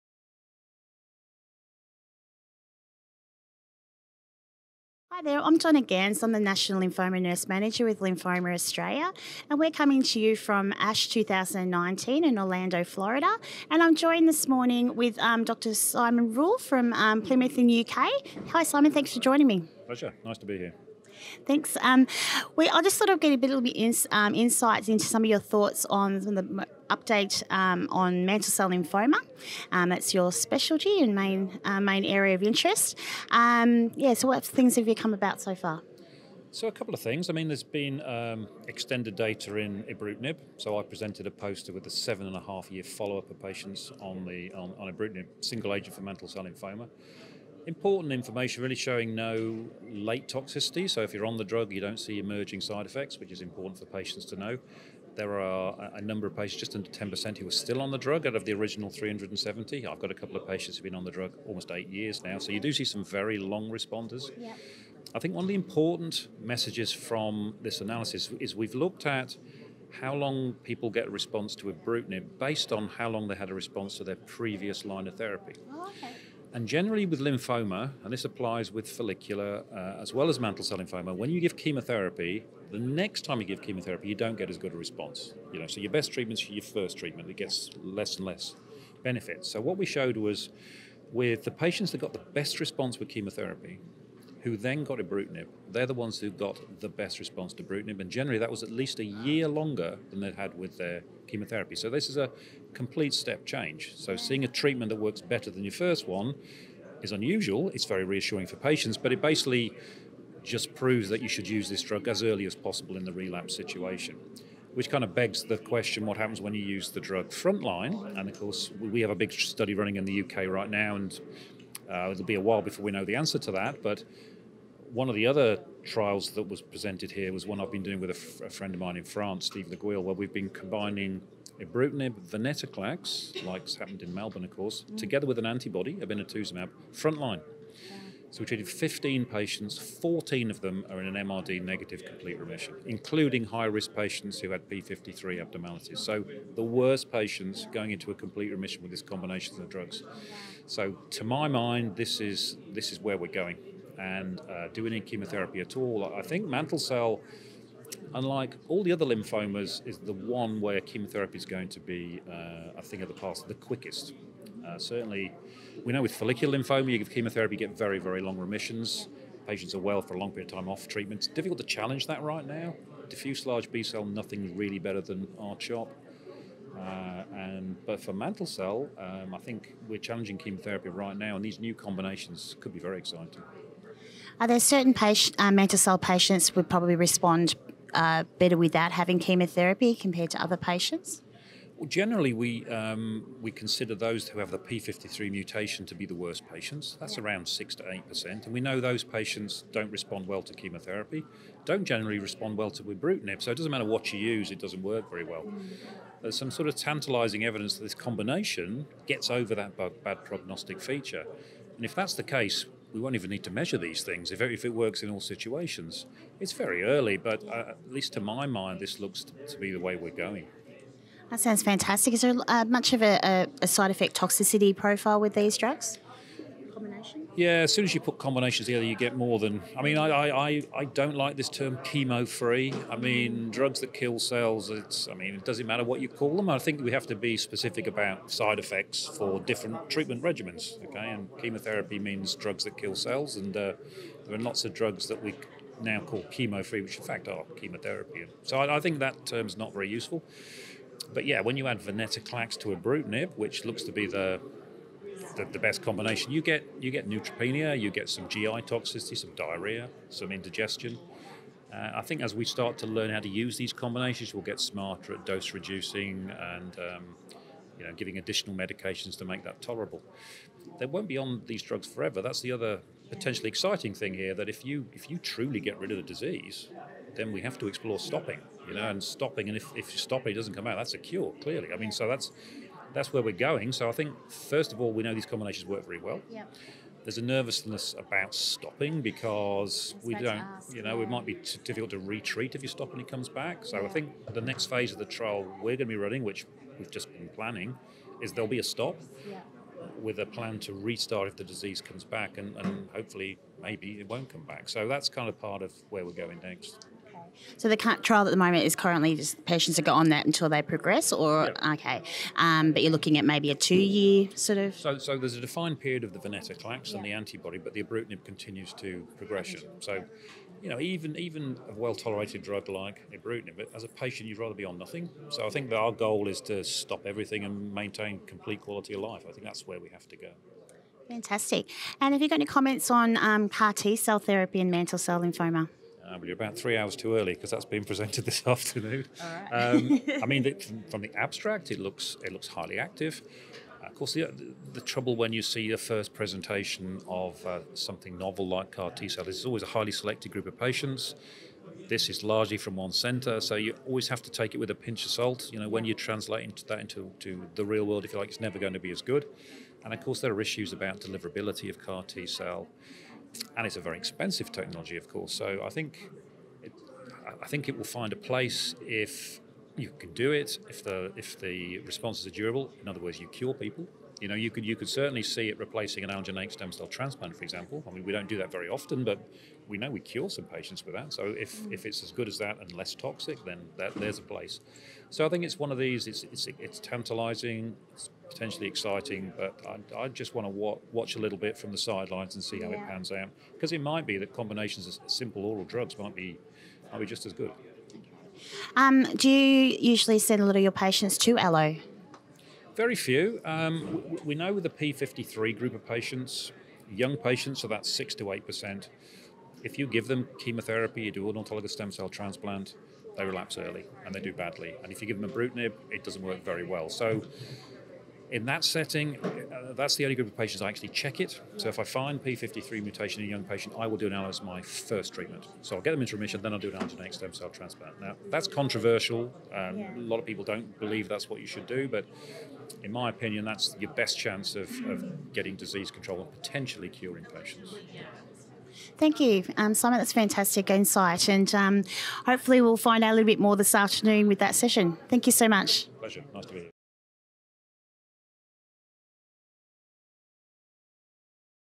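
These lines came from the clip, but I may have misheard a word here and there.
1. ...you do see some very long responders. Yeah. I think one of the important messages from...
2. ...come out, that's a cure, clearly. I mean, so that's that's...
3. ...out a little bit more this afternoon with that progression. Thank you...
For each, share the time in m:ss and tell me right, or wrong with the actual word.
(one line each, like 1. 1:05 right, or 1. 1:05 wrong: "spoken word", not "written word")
1. 1:02 right
2. 4:40 right
3. 7:23 wrong: "session", not "progression".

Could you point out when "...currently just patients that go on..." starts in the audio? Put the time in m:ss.
5:08.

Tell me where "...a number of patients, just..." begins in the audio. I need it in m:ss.
0:55.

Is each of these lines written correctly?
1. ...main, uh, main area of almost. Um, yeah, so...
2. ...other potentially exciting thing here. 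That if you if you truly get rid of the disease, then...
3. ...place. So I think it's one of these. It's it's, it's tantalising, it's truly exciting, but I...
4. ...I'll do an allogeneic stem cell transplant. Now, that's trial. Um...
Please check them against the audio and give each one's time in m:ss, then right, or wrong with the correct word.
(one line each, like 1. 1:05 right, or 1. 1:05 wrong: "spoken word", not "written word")
1. 0:31 wrong: "interest", not "almost"
2. 4:32 right
3. 6:24 wrong: "potentially", not "truly"
4. 7:06 wrong: "controversial", not "trial".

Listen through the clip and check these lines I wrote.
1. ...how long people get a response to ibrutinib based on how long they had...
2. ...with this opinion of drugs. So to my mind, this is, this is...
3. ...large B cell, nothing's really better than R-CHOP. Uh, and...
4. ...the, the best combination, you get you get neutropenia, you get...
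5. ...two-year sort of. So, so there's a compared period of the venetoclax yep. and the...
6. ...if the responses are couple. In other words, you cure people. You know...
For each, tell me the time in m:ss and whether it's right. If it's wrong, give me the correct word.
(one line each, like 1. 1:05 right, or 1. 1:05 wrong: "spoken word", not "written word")
1. 1:09 right
2. 2:28 wrong: "combination", not "opinion"
3. 2:53 right
4. 4:15 right
5. 5:13 wrong: "defined", not "compared"
6. 6:11 wrong: "durable", not "couple".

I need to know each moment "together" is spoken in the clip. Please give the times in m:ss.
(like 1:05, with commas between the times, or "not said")
2:14, 3:48.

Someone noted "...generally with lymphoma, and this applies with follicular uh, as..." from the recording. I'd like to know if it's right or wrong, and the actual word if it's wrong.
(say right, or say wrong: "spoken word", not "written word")
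right.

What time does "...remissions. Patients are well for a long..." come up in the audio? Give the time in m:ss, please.
2:48.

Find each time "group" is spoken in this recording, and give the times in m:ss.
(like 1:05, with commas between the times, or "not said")
5:50, 6:45, 7:00.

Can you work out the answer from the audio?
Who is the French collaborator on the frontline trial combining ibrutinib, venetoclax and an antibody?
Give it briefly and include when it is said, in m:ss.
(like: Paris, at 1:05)
Steve Le Gouill, at 2:09.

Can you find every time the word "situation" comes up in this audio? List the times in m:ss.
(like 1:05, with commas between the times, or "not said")
1:53, 3:35.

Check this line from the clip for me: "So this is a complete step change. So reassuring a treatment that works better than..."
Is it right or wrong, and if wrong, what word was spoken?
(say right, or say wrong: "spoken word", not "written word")
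wrong: "seeing", not "reassuring".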